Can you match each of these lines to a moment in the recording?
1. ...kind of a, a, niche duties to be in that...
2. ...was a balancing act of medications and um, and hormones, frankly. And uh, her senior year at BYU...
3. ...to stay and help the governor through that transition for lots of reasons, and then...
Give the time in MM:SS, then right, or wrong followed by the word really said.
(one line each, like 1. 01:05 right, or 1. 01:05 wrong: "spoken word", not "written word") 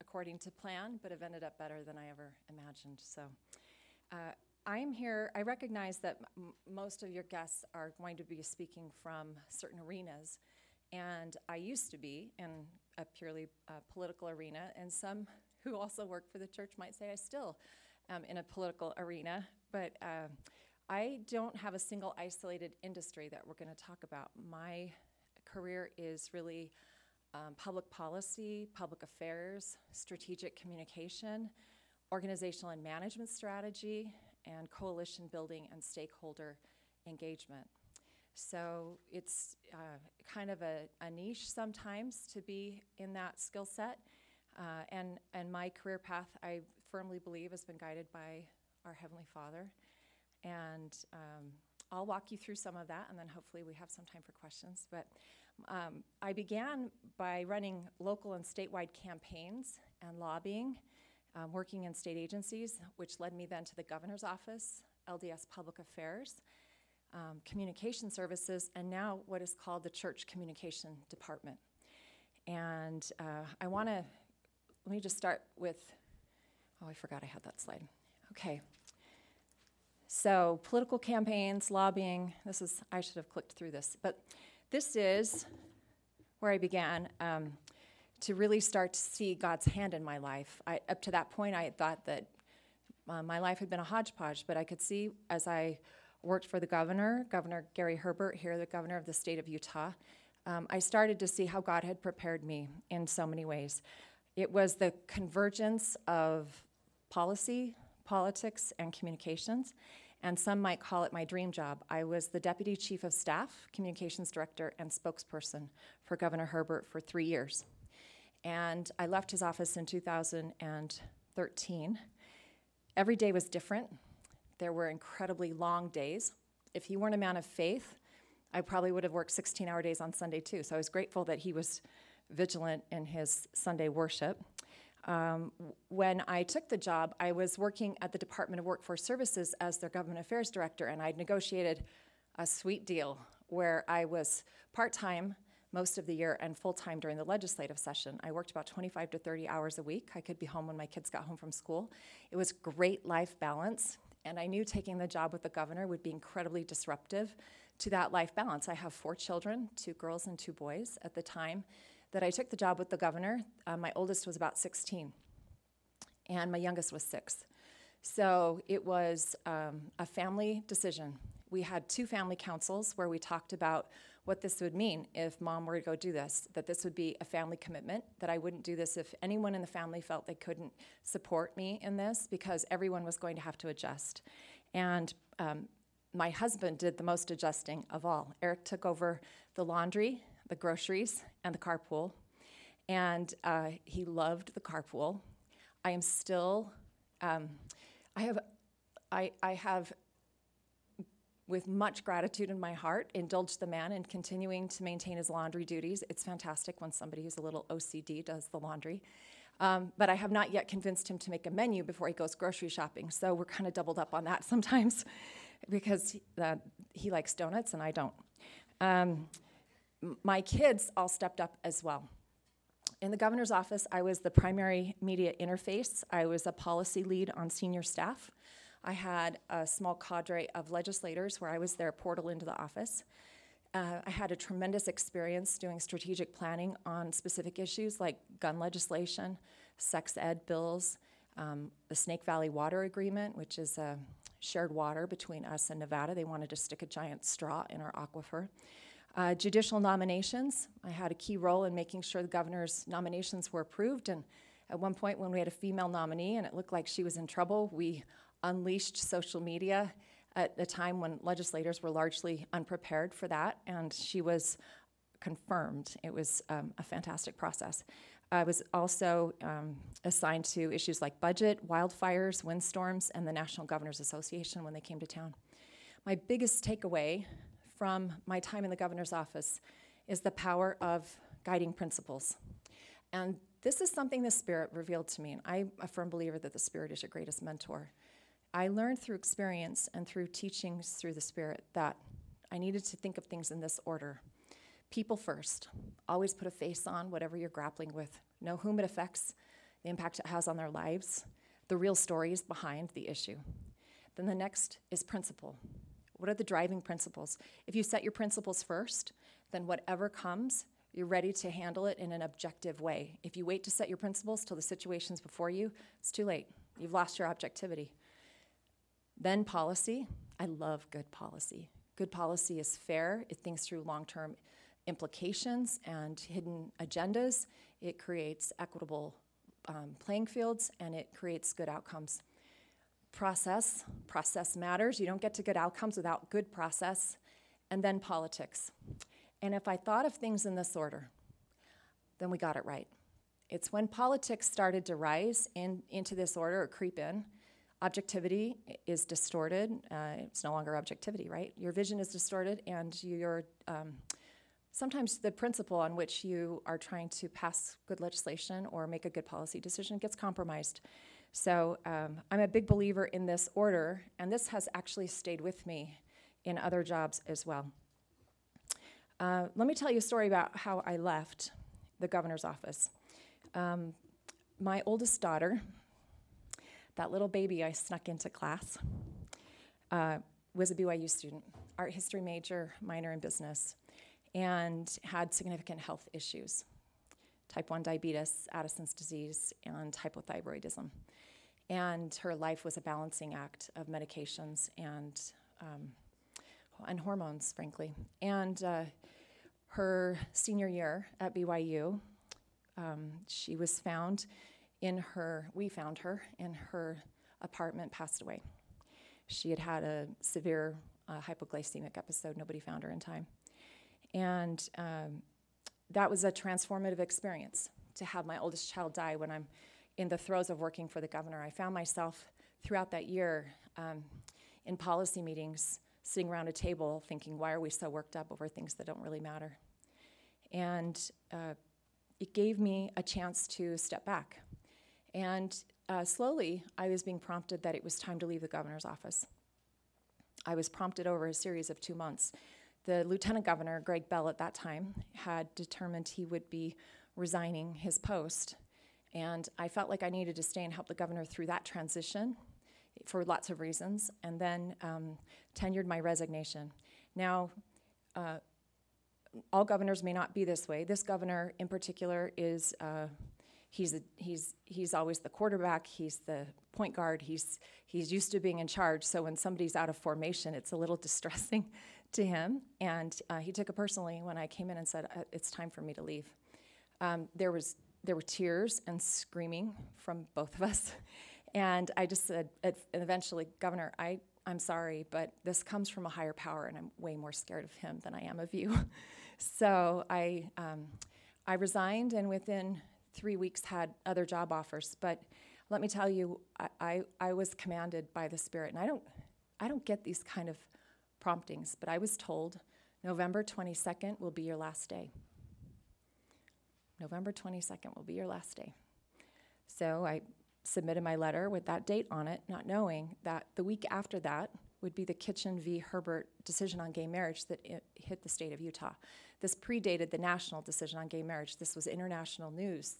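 1. 00:40 wrong: "sometimes", not "duties"
2. 06:32 right
3. 07:30 right.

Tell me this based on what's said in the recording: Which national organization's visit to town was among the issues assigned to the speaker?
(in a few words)
National Governors Association.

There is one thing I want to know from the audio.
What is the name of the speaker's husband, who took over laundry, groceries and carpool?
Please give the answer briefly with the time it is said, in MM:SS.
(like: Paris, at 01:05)
Eric, at 03:08.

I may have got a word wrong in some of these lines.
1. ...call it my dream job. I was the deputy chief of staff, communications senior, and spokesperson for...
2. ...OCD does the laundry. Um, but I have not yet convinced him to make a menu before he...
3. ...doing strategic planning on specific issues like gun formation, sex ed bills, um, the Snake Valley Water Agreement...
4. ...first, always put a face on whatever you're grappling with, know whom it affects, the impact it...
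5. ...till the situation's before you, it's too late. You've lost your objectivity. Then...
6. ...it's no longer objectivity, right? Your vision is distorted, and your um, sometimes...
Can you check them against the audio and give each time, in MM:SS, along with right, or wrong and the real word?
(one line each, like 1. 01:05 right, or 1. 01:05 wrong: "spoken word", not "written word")
1. 01:50 wrong: "director", not "senior"
2. 03:27 right
3. 03:55 wrong: "legislation", not "formation"
4. 04:55 right
5. 05:14 right
6. 05:50 right.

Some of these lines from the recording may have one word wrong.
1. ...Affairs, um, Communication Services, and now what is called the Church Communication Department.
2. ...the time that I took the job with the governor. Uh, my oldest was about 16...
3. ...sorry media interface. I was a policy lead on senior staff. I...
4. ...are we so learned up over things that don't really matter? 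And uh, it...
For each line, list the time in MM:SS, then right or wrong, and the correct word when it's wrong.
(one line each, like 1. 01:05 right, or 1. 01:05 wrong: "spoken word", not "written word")
1. 01:05 right
2. 02:41 right
3. 03:44 wrong: "primary", not "sorry"
4. 07:07 wrong: "worked", not "learned".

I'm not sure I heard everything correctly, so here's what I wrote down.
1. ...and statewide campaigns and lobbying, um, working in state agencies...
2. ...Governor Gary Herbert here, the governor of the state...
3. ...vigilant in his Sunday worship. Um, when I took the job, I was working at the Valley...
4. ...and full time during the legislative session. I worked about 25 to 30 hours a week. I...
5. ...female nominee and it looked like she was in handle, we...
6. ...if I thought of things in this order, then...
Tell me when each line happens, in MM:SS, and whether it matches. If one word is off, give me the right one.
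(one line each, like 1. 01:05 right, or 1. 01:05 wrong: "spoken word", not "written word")
1. 00:58 right
2. 01:37 right
3. 02:12 wrong: "Department", not "Valley"
4. 02:26 right
5. 04:15 wrong: "trouble", not "handle"
6. 05:39 right.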